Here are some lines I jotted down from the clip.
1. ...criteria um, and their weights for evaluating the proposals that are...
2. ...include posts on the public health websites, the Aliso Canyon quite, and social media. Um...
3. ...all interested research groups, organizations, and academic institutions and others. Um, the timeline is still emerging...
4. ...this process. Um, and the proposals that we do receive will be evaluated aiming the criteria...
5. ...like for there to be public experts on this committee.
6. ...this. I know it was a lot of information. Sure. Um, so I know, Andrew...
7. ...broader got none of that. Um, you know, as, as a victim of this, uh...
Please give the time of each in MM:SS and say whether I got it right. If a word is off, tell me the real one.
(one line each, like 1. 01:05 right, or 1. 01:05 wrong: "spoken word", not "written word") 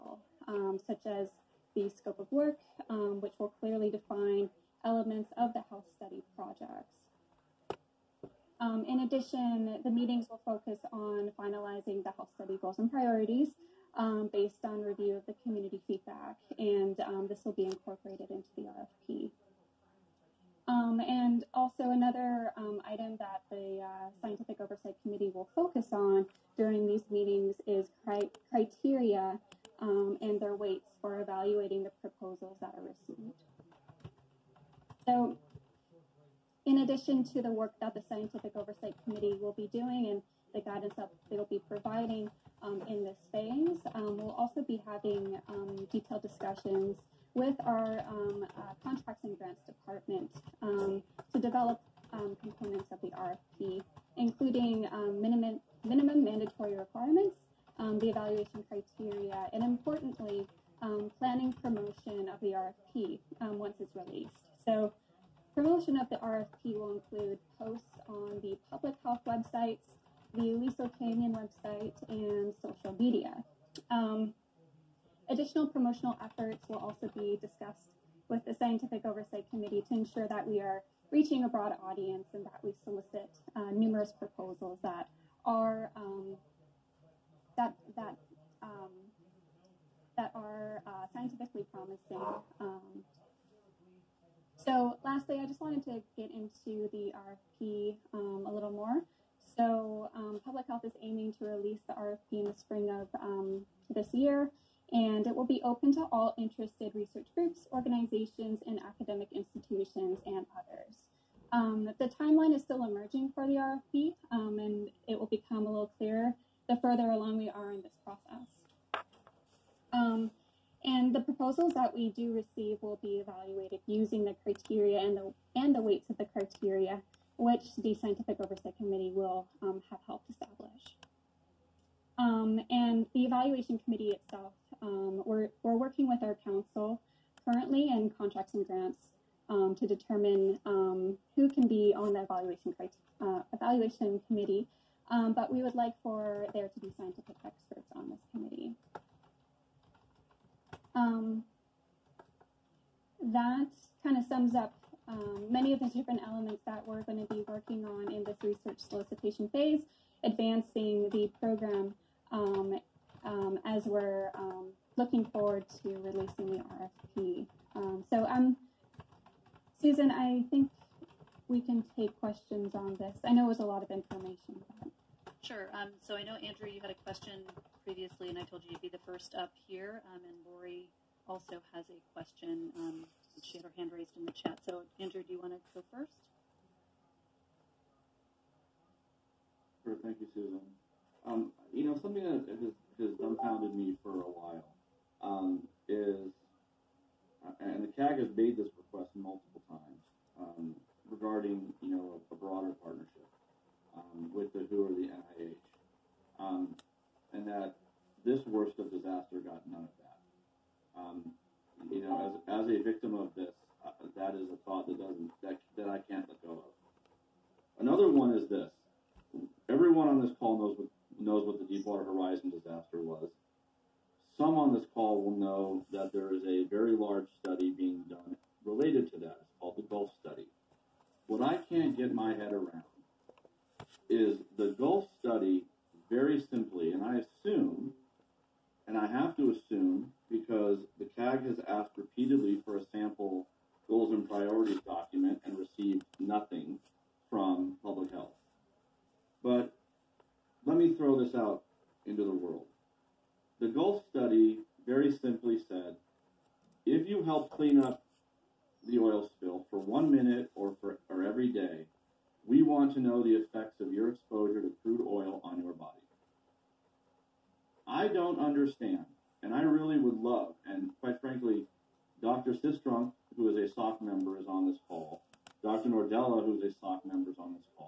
1. 00:28 right
2. 01:06 wrong: "website", not "quite"
3. 01:46 right
4. 01:57 wrong: "using", not "aiming"
5. 02:25 wrong: "scientific", not "public"
6. 02:52 right
7. 03:28 wrong: "disaster", not "broader".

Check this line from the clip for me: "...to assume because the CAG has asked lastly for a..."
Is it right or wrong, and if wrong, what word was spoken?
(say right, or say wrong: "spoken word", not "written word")
wrong: "repeatedly", not "lastly".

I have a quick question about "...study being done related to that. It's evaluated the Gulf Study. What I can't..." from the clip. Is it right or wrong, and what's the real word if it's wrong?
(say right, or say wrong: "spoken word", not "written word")
wrong: "called", not "evaluated".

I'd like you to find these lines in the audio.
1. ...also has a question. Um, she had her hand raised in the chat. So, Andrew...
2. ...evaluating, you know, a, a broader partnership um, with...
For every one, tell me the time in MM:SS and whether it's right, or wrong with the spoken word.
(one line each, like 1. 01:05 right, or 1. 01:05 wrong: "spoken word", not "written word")
1. 03:01 right
2. 03:21 wrong: "regarding", not "evaluating".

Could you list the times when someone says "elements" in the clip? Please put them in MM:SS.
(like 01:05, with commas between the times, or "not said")
00:04, 02:36.